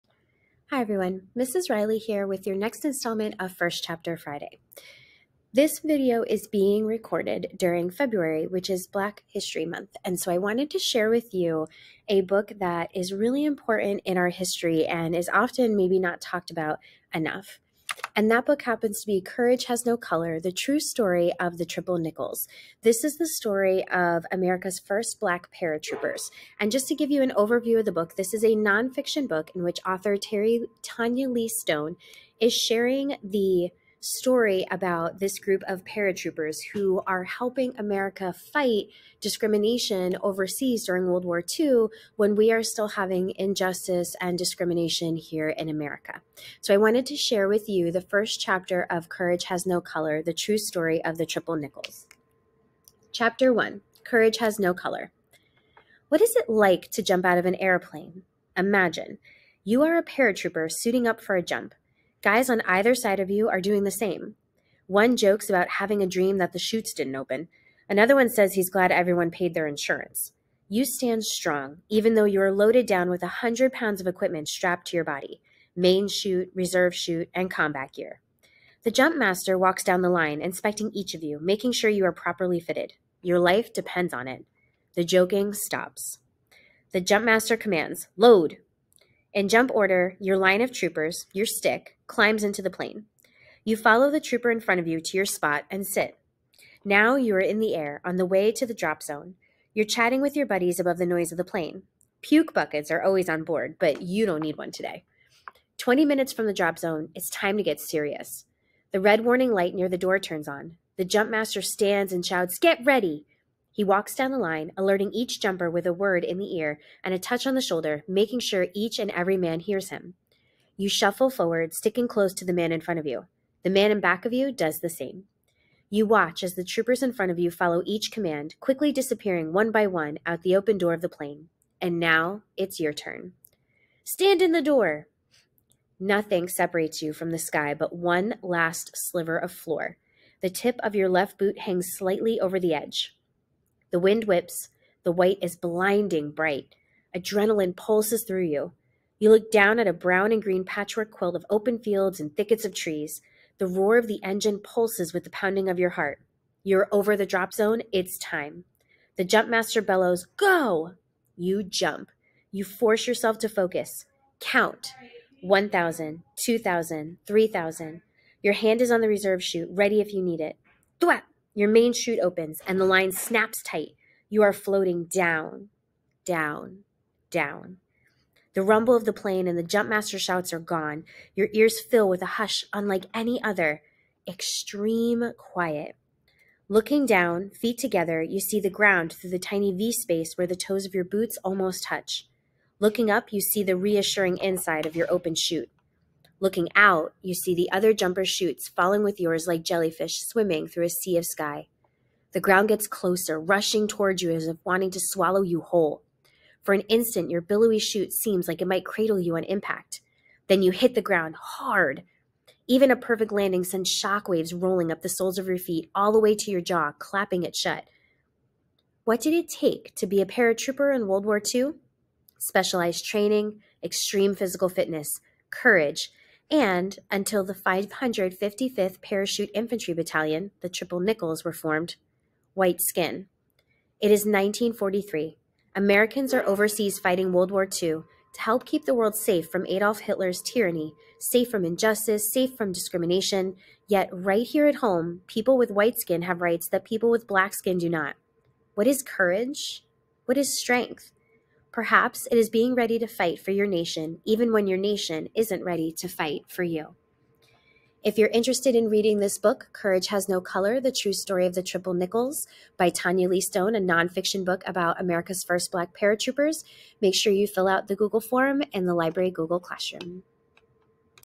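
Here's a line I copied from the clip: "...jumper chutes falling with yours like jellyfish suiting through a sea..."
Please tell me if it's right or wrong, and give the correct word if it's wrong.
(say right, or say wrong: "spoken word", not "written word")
wrong: "swimming", not "suiting".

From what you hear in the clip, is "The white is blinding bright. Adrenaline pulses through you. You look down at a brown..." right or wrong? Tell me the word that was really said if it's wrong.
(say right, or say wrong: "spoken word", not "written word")
right.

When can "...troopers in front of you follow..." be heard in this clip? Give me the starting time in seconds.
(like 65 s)
126 s.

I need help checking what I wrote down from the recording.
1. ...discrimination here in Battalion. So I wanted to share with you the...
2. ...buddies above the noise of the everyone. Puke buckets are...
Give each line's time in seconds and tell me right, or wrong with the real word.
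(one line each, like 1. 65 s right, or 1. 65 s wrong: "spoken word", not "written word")
1. 44 s wrong: "America", not "Battalion"
2. 100 s wrong: "plane", not "everyone".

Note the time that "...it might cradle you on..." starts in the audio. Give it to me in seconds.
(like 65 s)
208 s.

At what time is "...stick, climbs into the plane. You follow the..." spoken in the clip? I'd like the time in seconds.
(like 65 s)
91 s.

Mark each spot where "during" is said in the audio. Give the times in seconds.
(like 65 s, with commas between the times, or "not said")
7 s, 40 s.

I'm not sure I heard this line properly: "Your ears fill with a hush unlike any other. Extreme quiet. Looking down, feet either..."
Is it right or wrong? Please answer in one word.
wrong.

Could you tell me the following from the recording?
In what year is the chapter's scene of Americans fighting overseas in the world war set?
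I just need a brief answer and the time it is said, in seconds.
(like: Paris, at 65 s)
1943, at 234 s.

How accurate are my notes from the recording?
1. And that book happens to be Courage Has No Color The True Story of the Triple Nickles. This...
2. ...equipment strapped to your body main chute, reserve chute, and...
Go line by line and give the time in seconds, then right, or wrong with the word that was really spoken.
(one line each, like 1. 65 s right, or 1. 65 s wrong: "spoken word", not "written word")
1. 18 s right
2. 74 s right.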